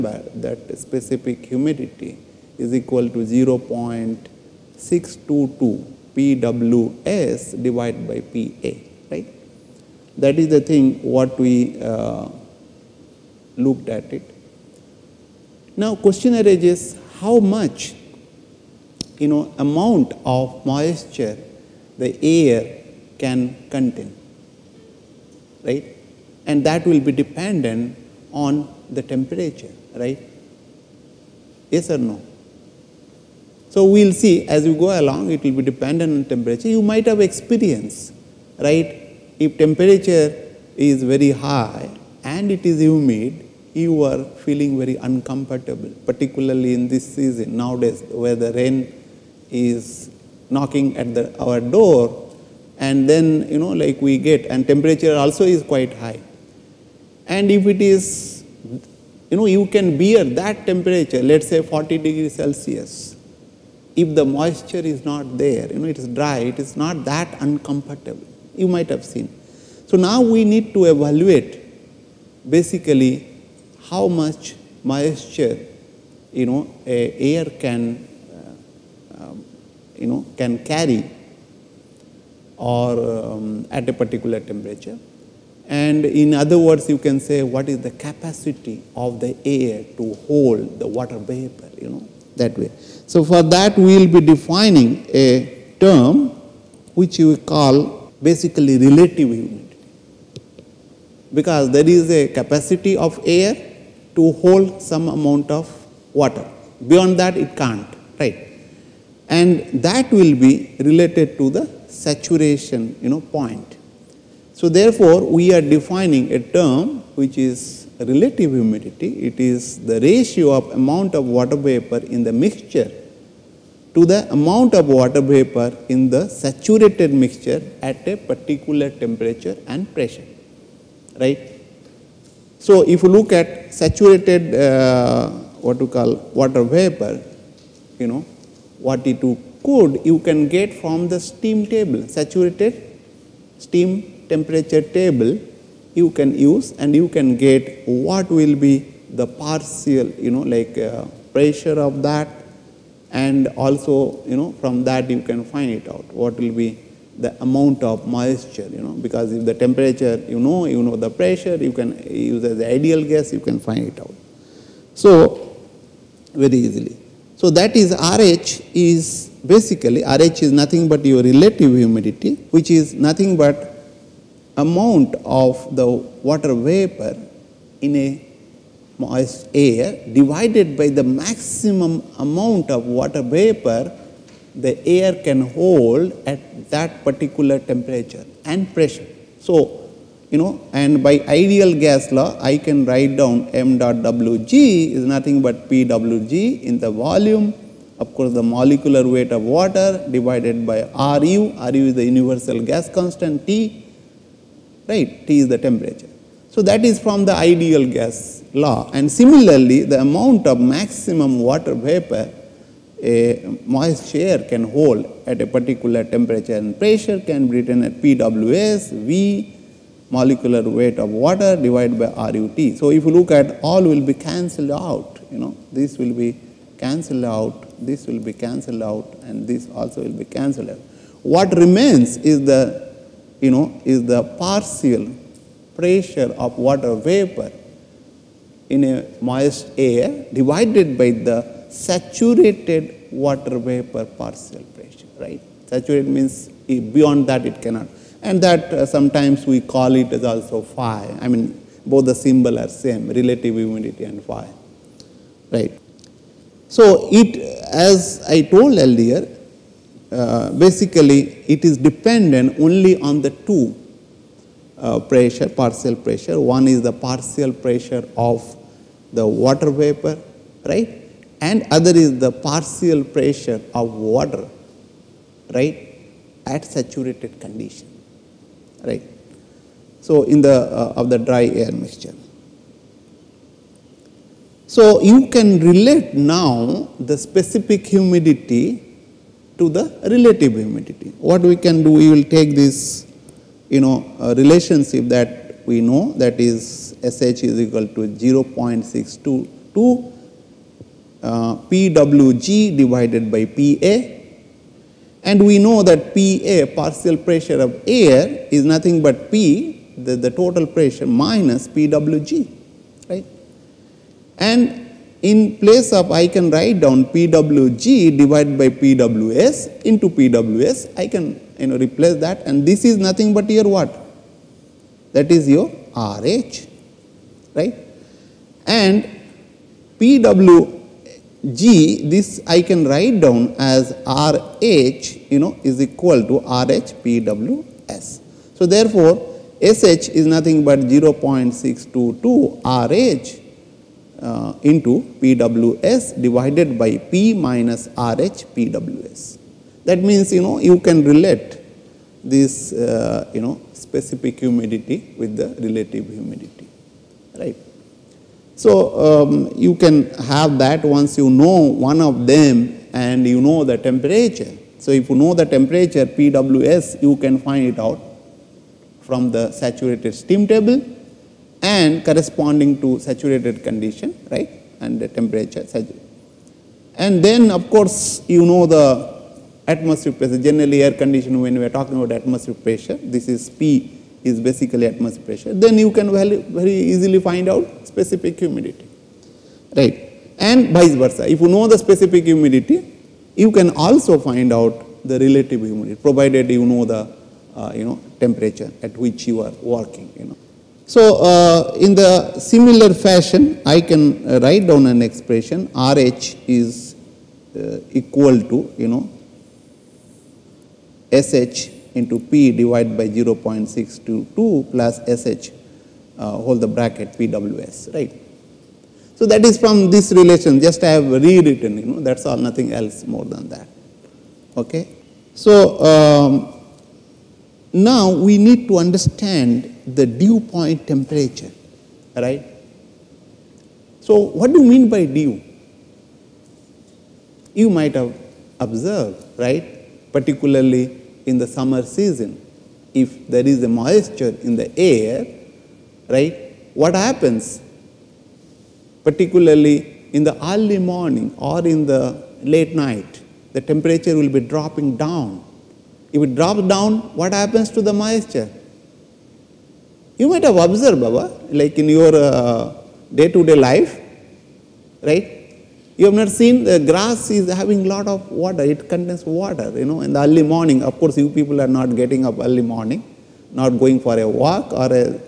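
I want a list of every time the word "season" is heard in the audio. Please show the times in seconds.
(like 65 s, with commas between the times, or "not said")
47 s, 441 s.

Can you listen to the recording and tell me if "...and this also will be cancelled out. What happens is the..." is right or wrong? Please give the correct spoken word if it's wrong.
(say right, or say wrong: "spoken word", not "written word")
wrong: "remains", not "happens".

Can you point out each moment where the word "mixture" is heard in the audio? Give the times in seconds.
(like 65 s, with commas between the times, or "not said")
122 s, 127 s, 281 s.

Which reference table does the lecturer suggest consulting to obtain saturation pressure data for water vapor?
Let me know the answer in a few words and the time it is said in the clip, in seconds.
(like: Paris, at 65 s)
saturated steam temperature table, at 142 s.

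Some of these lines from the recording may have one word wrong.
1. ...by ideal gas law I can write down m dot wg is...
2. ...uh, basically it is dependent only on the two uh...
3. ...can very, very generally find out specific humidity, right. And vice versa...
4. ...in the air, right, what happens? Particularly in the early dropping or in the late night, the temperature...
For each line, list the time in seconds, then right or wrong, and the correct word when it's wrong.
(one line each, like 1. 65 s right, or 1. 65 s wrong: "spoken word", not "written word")
1. 191 s right
2. 260 s right
3. 385 s wrong: "easily", not "generally"
4. 444 s wrong: "morning", not "dropping".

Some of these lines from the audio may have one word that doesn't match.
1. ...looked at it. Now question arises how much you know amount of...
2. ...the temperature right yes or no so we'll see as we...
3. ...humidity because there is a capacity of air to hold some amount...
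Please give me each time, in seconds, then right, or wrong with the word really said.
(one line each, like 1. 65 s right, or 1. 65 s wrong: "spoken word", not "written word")
1. 13 s right
2. 28 s right
3. 99 s right.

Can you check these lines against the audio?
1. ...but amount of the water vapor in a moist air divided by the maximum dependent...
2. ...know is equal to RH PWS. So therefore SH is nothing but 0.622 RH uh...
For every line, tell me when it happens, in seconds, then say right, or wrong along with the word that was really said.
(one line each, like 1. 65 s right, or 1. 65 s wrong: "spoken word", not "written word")
1. 173 s wrong: "amount", not "dependent"
2. 335 s right.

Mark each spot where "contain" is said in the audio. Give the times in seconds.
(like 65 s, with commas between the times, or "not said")
23 s, 468 s.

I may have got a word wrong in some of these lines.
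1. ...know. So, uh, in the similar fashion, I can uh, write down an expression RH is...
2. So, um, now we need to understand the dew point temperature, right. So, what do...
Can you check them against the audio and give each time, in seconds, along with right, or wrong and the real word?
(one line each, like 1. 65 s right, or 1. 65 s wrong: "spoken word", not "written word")
1. 400 s right
2. 425 s right.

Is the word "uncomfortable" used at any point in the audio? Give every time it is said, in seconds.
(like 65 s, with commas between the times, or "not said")
44 s, 67 s.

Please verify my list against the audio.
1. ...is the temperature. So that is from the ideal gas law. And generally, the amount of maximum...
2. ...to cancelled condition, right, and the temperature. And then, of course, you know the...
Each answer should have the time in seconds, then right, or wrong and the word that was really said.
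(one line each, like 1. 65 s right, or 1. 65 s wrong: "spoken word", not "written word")
1. 205 s wrong: "similarly", not "generally"
2. 372 s wrong: "saturated", not "cancelled".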